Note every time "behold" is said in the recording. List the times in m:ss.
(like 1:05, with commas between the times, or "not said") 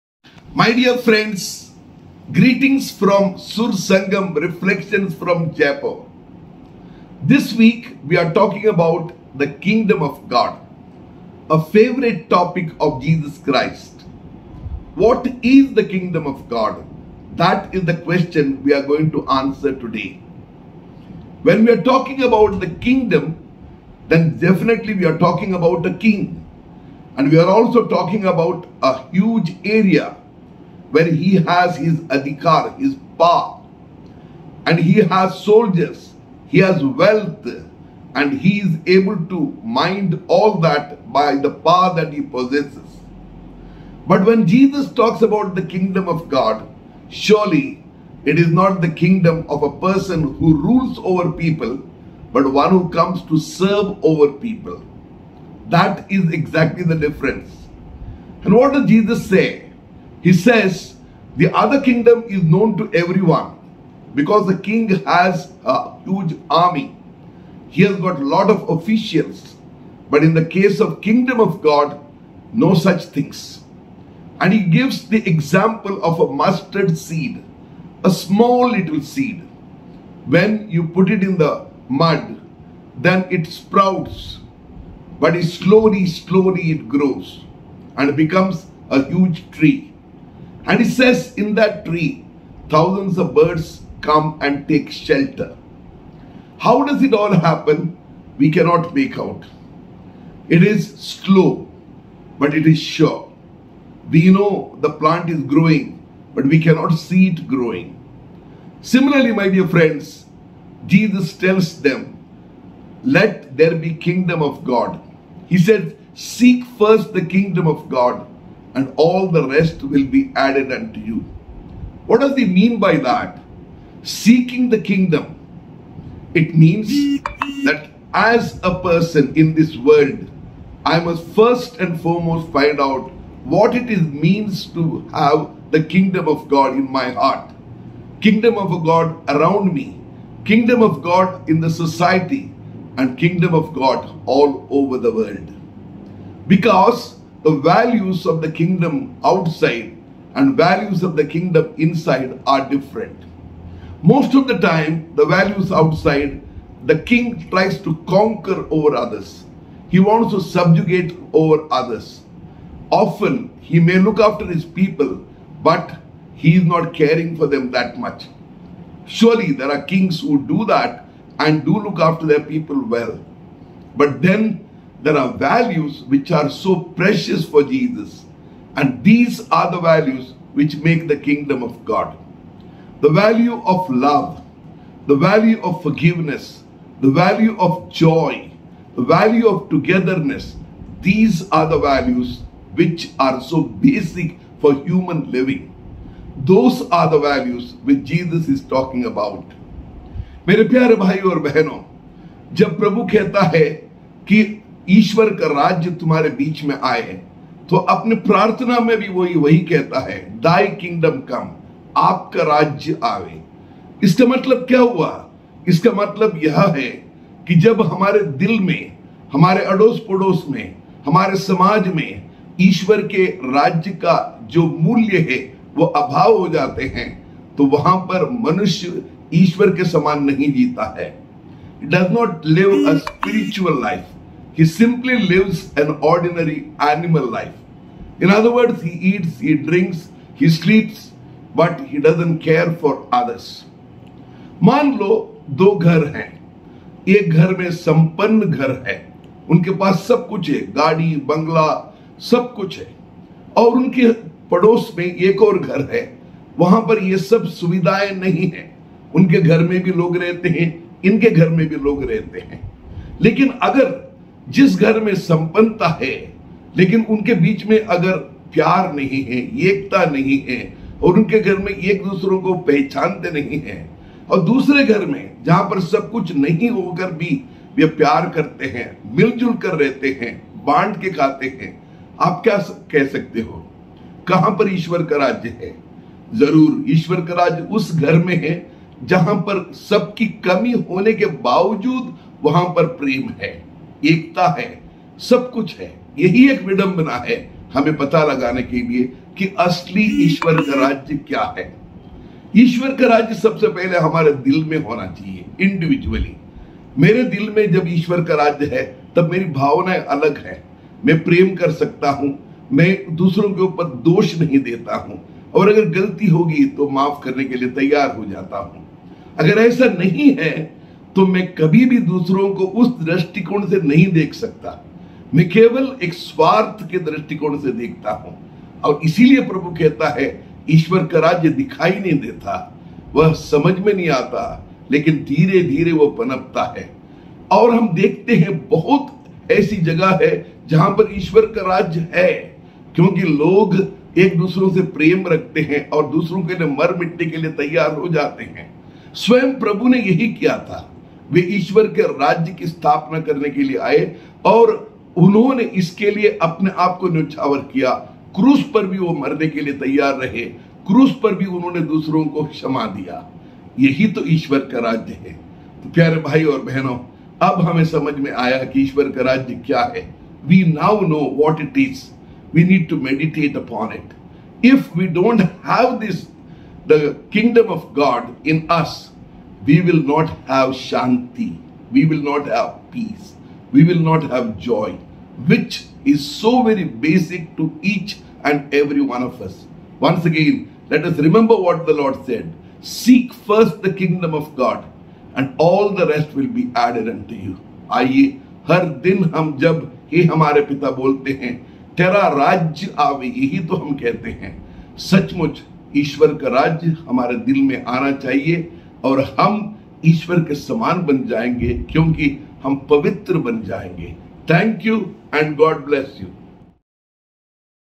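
not said.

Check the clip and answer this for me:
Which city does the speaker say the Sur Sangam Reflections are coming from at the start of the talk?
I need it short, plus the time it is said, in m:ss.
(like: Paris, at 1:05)
Jaipur, at 0:05.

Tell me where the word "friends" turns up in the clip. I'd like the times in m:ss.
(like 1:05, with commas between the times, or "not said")
0:00, 1:49.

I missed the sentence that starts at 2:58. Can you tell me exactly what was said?
And these are the values which make the kingdom of God.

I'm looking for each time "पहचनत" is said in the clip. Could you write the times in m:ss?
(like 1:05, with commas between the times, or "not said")
4:32.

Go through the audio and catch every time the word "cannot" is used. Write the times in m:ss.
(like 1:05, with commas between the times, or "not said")
1:38, 1:46.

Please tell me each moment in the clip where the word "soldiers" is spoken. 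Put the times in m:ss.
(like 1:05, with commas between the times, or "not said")
0:35.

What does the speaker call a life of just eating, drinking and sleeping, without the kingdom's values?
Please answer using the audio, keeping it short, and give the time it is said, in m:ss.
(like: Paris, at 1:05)
Animal life, at 3:56.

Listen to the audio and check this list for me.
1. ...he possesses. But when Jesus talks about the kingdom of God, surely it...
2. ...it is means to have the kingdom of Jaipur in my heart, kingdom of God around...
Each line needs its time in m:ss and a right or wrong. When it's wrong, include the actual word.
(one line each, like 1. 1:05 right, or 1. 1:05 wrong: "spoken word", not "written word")
1. 0:42 right
2. 2:13 wrong: "God", not "Jaipur".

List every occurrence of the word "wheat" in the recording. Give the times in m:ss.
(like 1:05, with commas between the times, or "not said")
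not said.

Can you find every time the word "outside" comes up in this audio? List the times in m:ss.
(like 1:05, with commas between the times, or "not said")
2:29, 2:35.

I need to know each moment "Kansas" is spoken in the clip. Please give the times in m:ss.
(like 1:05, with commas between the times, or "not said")
not said.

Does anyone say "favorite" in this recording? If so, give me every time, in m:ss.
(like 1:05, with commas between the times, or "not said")
0:11.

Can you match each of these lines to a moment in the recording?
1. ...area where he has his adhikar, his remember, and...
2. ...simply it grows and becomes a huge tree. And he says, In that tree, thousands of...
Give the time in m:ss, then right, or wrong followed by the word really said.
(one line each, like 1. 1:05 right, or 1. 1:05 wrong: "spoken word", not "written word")
1. 0:29 wrong: "power", not "remember"
2. 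1:26 wrong: "slowly", not "simply".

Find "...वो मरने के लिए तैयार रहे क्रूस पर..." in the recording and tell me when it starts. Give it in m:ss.
5:58.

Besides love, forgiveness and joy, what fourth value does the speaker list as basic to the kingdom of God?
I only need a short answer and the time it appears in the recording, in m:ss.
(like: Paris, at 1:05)
Togetherness, at 3:08.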